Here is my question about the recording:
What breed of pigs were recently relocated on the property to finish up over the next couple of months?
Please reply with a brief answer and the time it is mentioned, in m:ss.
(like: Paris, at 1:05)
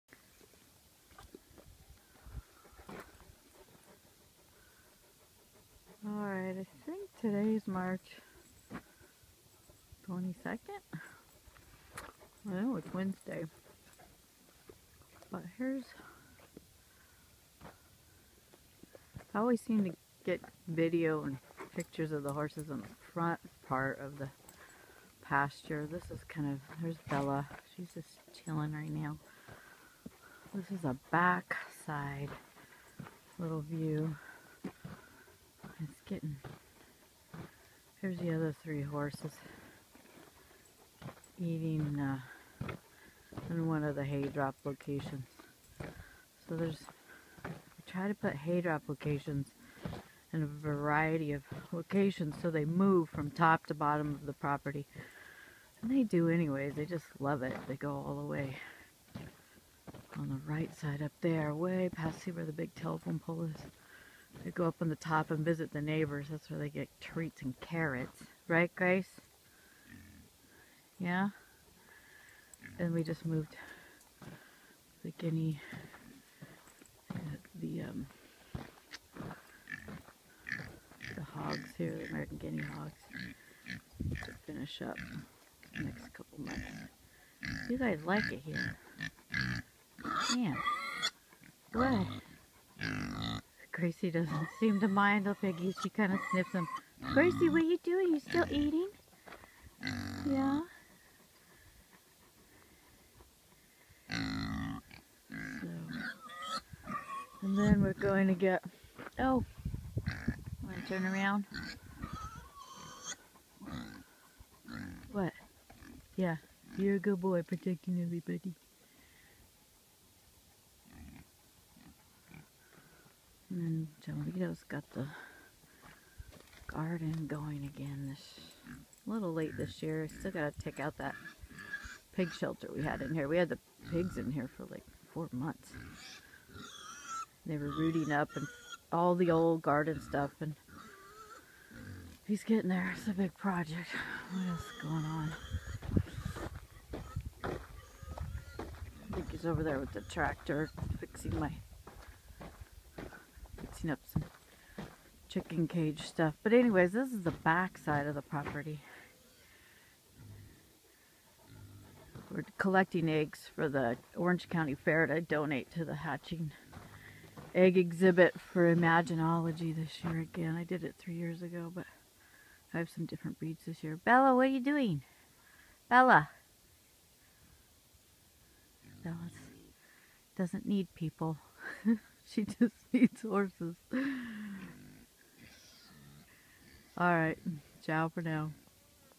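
American guinea hogs, at 1:22.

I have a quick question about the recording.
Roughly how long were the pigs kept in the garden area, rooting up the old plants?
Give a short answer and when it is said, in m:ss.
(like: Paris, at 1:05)
4 months, at 2:15.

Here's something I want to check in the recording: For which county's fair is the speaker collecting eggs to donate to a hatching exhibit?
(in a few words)
Orange County.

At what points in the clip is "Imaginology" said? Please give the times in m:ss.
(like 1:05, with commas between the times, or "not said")
2:48.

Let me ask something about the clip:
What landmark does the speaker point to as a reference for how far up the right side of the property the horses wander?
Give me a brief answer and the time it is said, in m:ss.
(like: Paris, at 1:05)
The big telephone pole, at 1:02.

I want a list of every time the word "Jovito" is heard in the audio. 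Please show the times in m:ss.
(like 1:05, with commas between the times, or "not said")
2:04.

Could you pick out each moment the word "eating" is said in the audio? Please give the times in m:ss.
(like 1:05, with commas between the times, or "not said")
0:41, 1:38.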